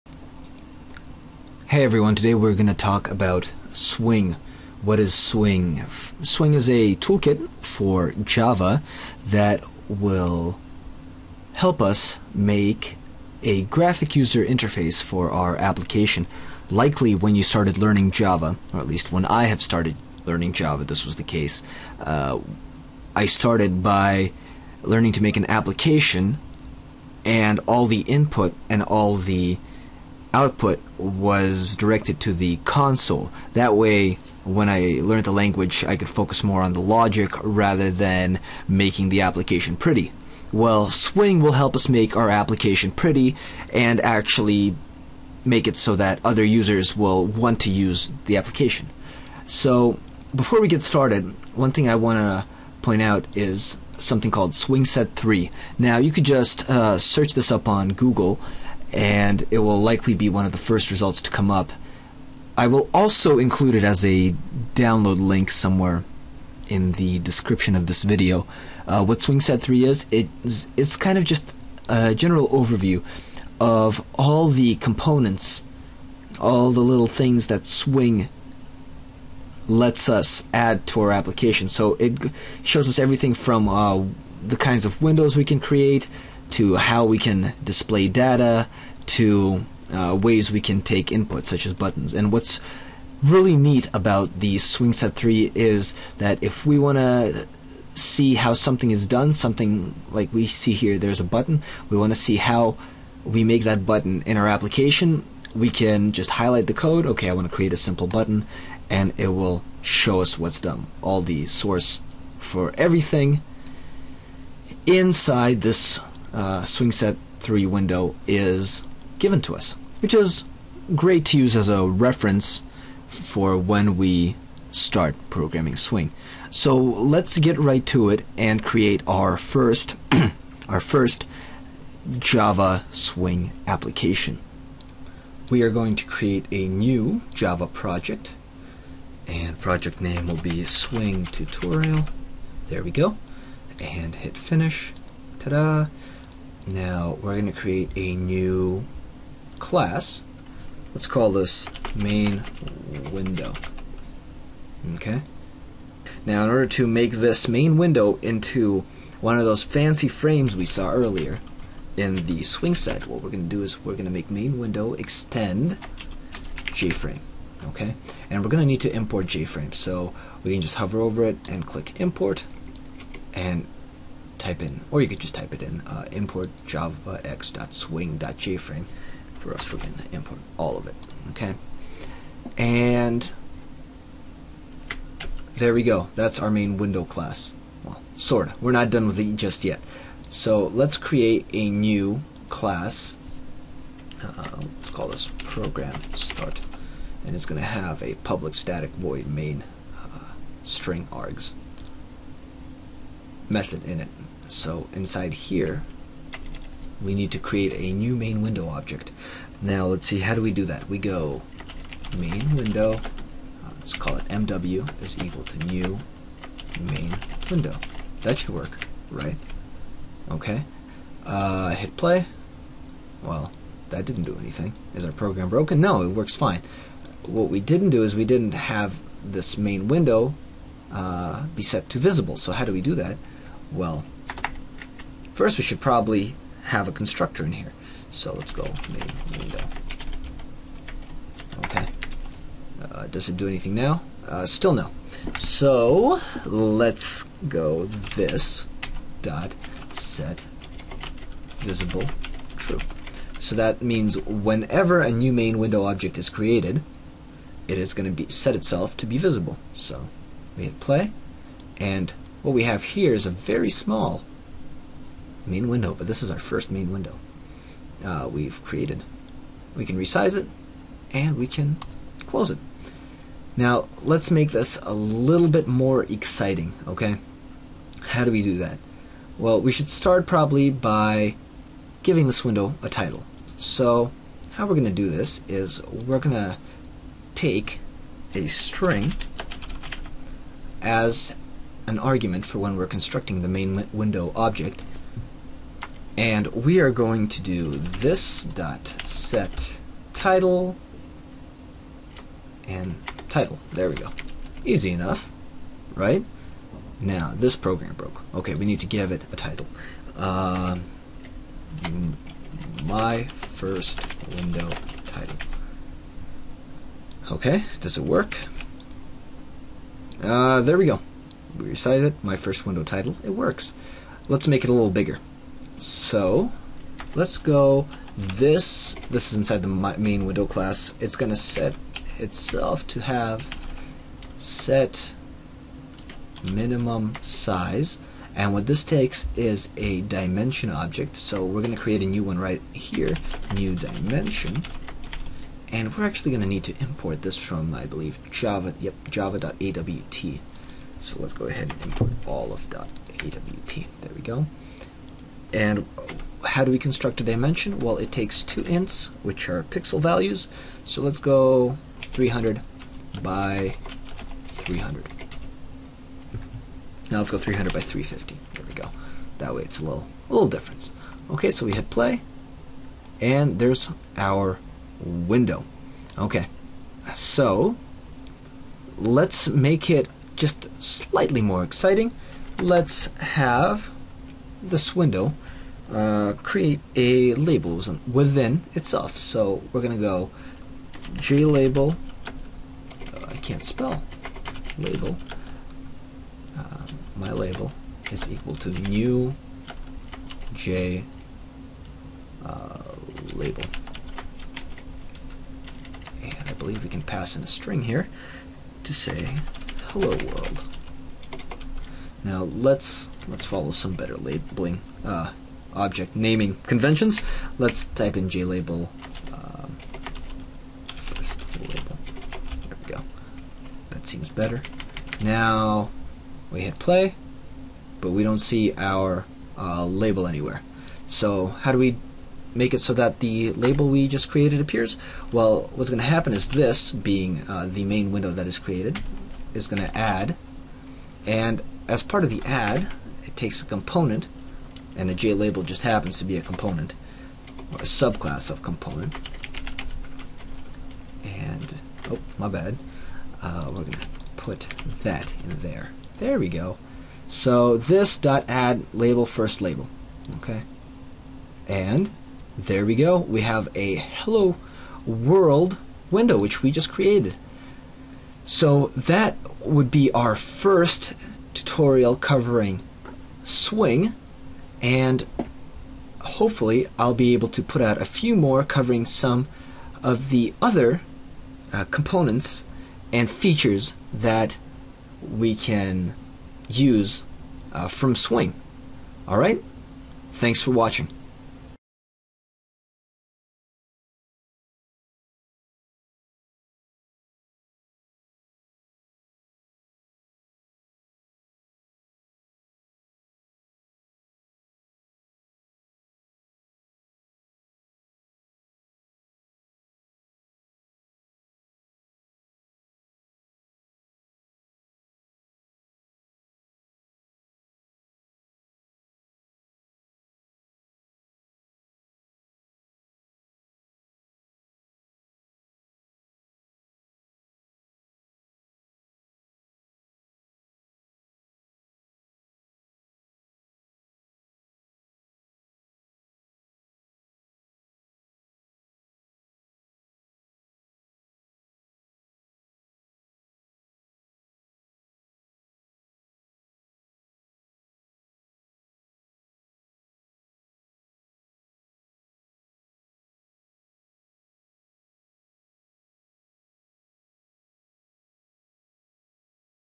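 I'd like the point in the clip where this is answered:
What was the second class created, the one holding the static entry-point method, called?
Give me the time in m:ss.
3:15.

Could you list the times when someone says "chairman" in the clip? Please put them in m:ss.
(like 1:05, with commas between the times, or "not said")
not said.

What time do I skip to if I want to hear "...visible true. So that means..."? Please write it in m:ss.
4:11.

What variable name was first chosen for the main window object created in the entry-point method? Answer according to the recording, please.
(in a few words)
MW.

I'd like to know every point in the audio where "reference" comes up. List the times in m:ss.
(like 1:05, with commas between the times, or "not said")
2:01.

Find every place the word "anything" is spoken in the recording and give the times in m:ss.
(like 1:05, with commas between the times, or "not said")
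3:44, 4:03.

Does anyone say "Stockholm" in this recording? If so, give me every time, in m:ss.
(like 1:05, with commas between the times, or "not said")
not said.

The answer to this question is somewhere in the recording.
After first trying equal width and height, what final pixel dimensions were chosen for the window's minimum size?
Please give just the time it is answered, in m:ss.
6:07.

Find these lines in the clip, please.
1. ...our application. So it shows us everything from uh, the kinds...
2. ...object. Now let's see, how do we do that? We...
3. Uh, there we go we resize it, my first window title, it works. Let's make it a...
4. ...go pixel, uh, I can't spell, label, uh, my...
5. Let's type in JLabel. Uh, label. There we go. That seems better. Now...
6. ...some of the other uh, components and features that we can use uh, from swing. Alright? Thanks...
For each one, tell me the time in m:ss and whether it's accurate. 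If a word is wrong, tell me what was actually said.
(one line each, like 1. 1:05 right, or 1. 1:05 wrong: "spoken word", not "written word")
1. 1:21 right
2. 3:28 right
3. 5:20 right
4. 6:30 wrong: "jlabel", not "pixel"
5. 6:57 right
6. 7:59 right.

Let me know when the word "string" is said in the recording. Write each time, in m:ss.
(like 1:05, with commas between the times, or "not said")
3:20, 4:48, 6:47.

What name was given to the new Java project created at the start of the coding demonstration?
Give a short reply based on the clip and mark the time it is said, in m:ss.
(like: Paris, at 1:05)
swing tutorial, at 2:20.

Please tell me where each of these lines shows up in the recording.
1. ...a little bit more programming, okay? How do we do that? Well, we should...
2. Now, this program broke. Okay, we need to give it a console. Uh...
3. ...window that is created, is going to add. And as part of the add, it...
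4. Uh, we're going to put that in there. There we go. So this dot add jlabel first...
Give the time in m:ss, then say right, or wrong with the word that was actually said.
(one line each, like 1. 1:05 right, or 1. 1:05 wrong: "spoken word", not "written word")
1. 4:34 wrong: "exciting", not "programming"
2. 5:06 wrong: "title", not "console"
3. 7:18 right
4. 7:33 wrong: "label", not "jlabel".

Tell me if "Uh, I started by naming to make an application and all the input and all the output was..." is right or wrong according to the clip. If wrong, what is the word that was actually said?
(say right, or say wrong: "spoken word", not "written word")
wrong: "learning", not "naming".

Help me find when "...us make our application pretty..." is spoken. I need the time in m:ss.
0:41.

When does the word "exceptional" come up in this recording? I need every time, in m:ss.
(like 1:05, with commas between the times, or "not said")
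not said.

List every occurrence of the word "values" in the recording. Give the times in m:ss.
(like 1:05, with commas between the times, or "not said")
5:59.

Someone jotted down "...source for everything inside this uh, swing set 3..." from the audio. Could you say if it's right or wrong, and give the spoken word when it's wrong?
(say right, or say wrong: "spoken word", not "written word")
right.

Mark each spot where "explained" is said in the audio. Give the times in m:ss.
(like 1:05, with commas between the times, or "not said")
not said.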